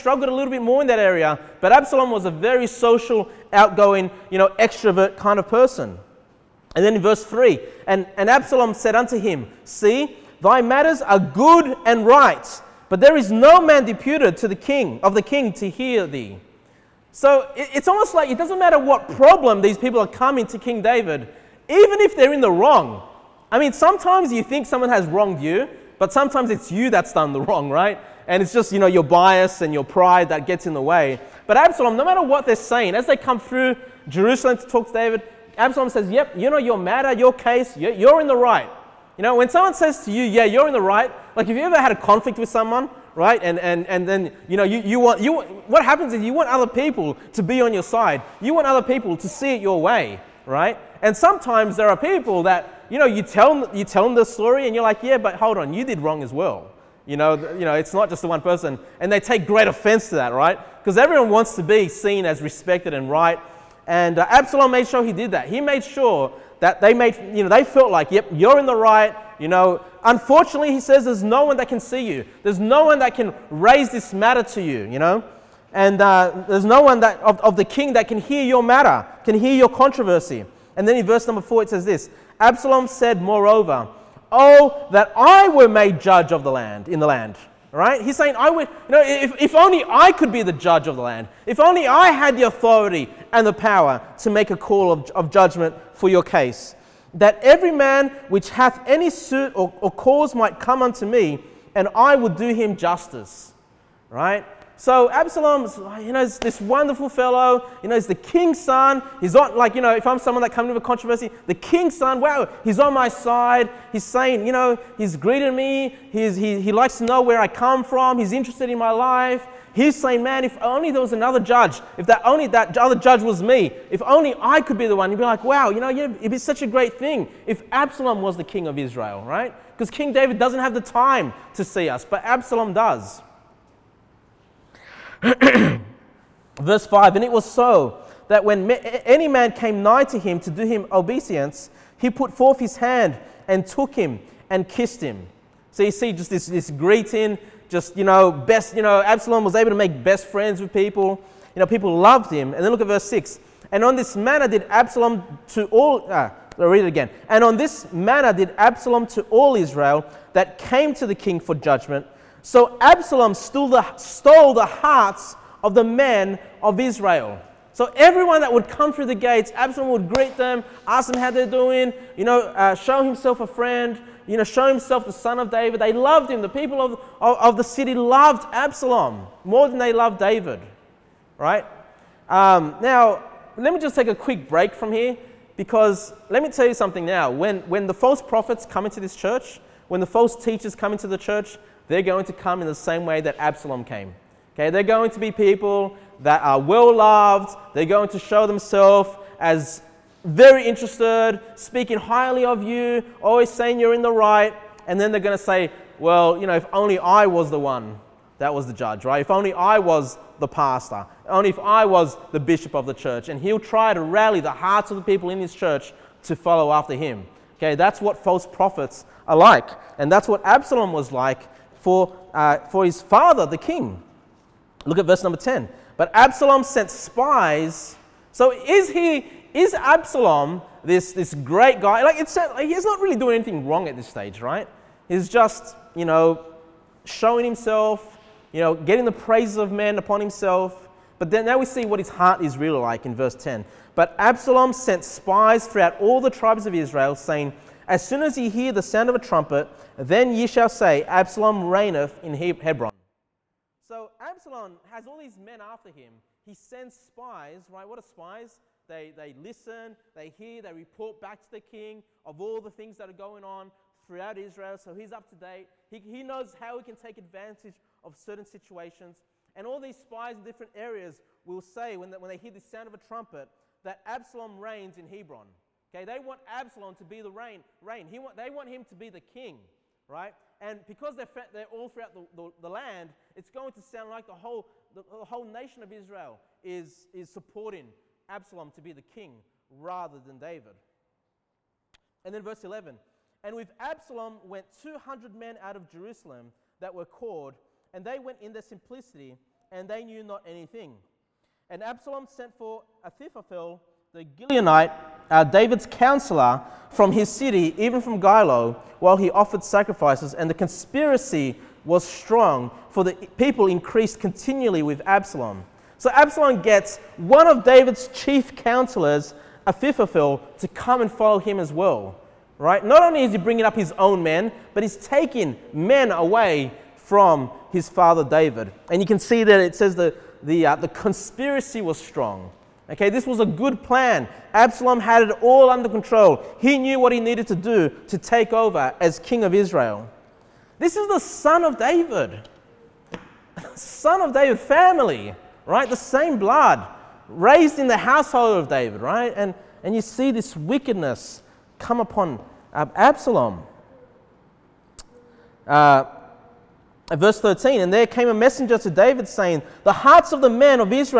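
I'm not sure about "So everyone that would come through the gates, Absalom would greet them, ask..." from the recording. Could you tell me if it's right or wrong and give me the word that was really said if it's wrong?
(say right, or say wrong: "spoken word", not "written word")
right.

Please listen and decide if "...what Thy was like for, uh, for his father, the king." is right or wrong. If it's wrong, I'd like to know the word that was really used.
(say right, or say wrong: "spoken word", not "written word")
wrong: "Absalom", not "Thy".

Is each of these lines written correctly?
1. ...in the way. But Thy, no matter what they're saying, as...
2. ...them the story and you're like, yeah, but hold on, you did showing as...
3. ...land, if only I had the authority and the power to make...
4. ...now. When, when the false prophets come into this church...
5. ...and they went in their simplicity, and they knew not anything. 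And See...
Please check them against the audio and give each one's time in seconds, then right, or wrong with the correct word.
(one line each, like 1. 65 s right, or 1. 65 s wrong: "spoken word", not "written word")
1. 30 s wrong: "Absalom", not "Thy"
2. 54 s wrong: "wrong", not "showing"
3. 91 s right
4. 187 s right
5. 297 s wrong: "Absalom", not "See".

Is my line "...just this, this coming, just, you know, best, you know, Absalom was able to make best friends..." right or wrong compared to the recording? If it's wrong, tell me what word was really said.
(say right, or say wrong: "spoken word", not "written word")
wrong: "greeting", not "coming".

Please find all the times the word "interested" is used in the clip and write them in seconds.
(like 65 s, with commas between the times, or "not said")
118 s, 200 s.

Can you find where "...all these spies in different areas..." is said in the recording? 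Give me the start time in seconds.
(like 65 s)
269 s.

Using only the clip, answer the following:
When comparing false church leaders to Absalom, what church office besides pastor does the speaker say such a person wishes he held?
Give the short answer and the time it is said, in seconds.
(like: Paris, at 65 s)
bishop, at 212 s.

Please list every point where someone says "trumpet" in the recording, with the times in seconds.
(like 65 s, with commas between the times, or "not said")
249 s, 272 s.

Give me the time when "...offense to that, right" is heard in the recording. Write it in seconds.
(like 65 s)
59 s.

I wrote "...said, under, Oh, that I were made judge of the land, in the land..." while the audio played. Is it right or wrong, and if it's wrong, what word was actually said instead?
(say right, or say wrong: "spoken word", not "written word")
wrong: "moreover", not "under".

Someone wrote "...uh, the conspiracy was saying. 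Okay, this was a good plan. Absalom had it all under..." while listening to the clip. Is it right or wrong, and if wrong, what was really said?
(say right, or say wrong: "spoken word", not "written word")
wrong: "strong", not "saying".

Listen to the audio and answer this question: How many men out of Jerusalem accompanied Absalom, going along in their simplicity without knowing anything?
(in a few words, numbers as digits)
200.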